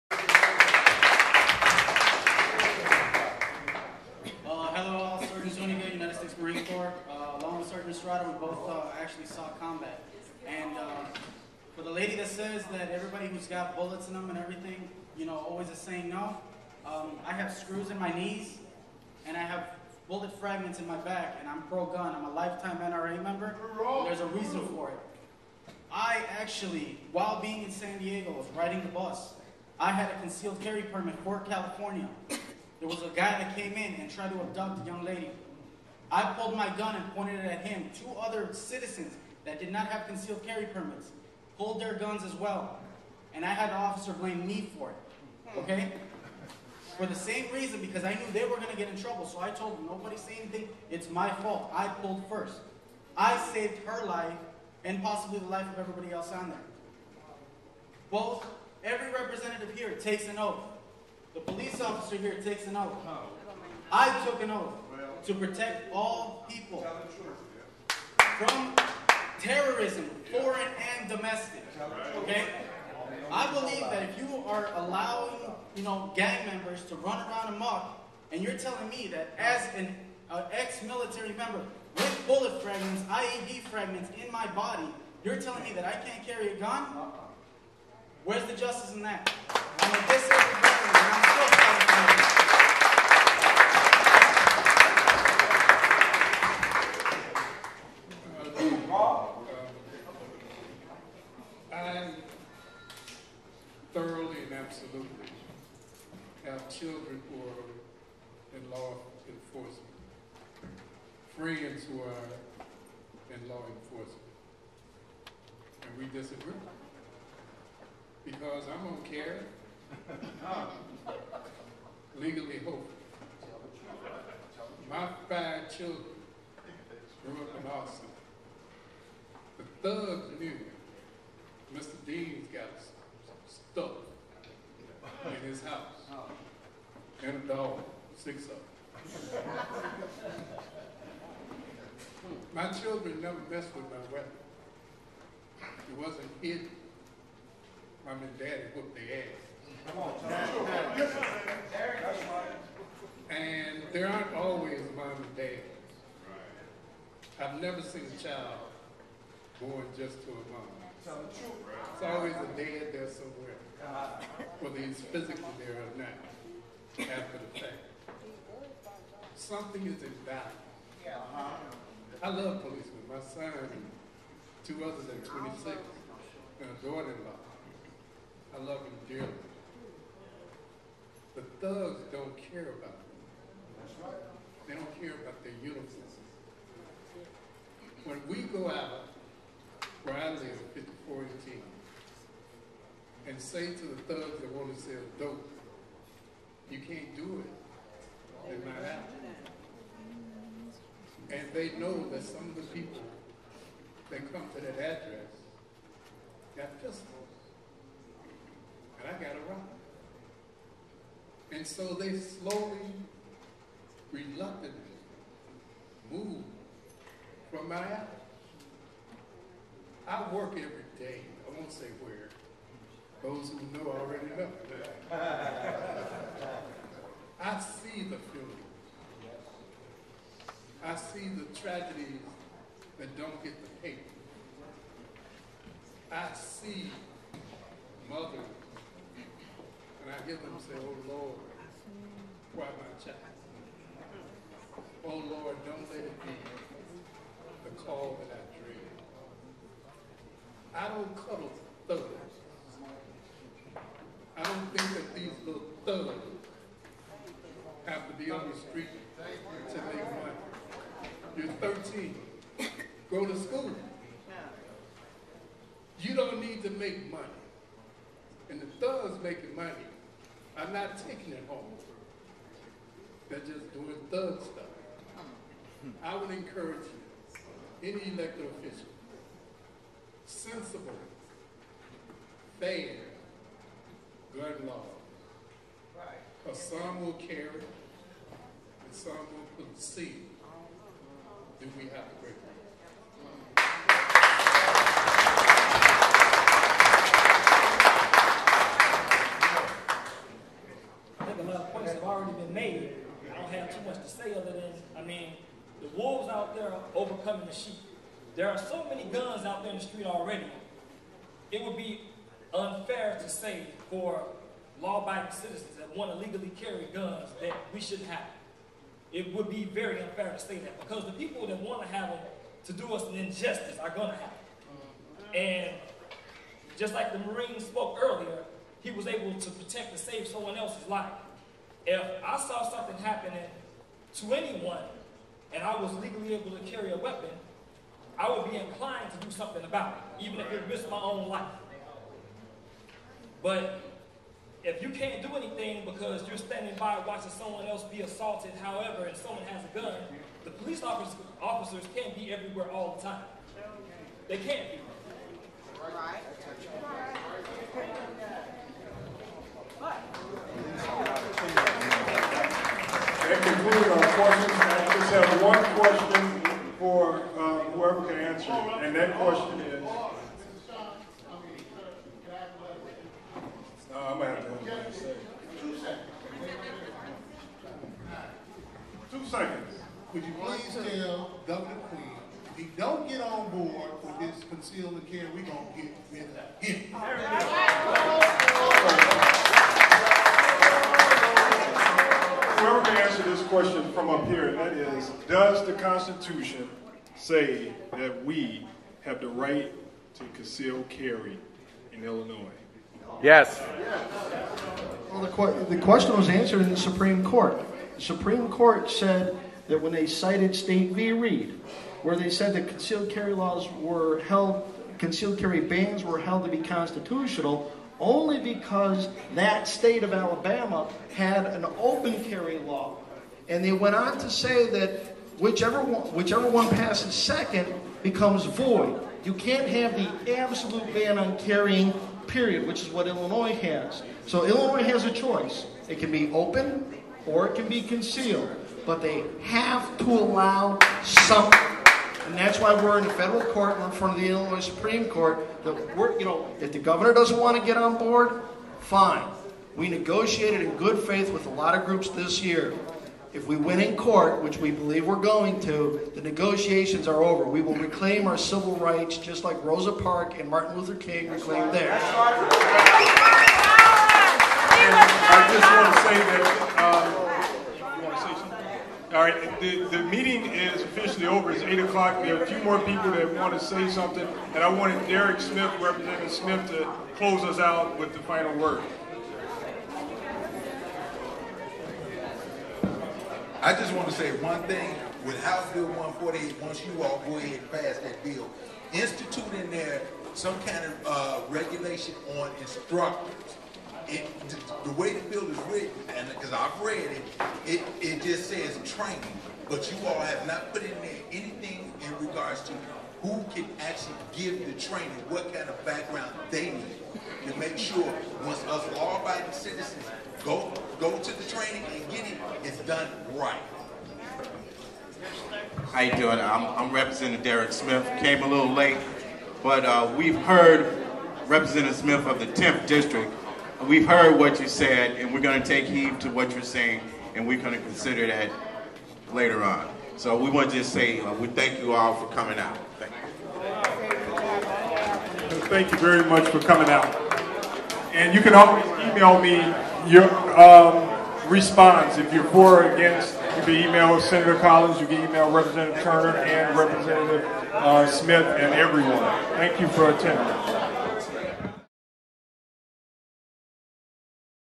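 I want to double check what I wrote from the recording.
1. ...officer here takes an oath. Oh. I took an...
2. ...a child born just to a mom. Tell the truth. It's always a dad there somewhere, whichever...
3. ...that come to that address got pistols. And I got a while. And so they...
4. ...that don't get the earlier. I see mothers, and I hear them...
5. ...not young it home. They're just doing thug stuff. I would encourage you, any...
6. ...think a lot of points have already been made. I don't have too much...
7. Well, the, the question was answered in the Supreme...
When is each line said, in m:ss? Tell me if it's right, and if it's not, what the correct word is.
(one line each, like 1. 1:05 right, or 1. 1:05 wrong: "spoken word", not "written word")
1. 1:01 right
2. 2:38 wrong: "whether", not "whichever"
3. 3:24 wrong: "rifle", not "while"
4. 3:52 wrong: "paper", not "earlier"
5. 4:30 wrong: "taking", not "young"
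6. 5:01 right
7. 6:45 right.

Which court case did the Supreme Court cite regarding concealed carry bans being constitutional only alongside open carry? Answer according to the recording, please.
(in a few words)
State v. Reid.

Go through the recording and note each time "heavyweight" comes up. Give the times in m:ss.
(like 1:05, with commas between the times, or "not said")
not said.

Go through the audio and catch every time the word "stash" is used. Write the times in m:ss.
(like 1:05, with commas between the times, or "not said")
not said.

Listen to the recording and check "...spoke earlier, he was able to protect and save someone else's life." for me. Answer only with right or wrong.
right.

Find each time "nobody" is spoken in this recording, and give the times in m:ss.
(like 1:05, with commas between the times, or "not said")
0:49.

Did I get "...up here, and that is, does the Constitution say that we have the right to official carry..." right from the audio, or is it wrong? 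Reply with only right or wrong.
wrong.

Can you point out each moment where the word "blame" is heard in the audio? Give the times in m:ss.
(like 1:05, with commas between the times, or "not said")
0:44.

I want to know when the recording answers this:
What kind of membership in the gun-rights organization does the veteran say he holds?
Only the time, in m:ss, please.
0:22.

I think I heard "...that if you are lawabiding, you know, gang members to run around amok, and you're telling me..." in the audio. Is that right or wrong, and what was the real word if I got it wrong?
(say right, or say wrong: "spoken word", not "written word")
wrong: "allowing", not "lawabiding".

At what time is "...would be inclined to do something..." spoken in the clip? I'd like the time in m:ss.
5:38.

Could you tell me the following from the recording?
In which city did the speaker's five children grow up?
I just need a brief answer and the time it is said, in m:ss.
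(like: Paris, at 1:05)
Austin, at 2:07.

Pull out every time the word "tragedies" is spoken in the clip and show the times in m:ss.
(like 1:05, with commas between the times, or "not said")
3:51.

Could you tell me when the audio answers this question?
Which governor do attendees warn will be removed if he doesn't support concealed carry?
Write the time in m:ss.
6:21.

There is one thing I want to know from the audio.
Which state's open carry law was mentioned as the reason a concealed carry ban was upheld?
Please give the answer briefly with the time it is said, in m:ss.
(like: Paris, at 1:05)
Alabama, at 7:00.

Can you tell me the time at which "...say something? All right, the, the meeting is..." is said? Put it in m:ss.
7:48.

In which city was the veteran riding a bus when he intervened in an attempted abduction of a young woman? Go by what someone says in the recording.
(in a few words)
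San Diego.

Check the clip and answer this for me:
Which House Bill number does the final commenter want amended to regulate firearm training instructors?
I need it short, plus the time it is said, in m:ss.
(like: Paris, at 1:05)
148, at 8:05.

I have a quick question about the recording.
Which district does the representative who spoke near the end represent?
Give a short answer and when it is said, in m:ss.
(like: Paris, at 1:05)
10th District, at 8:42.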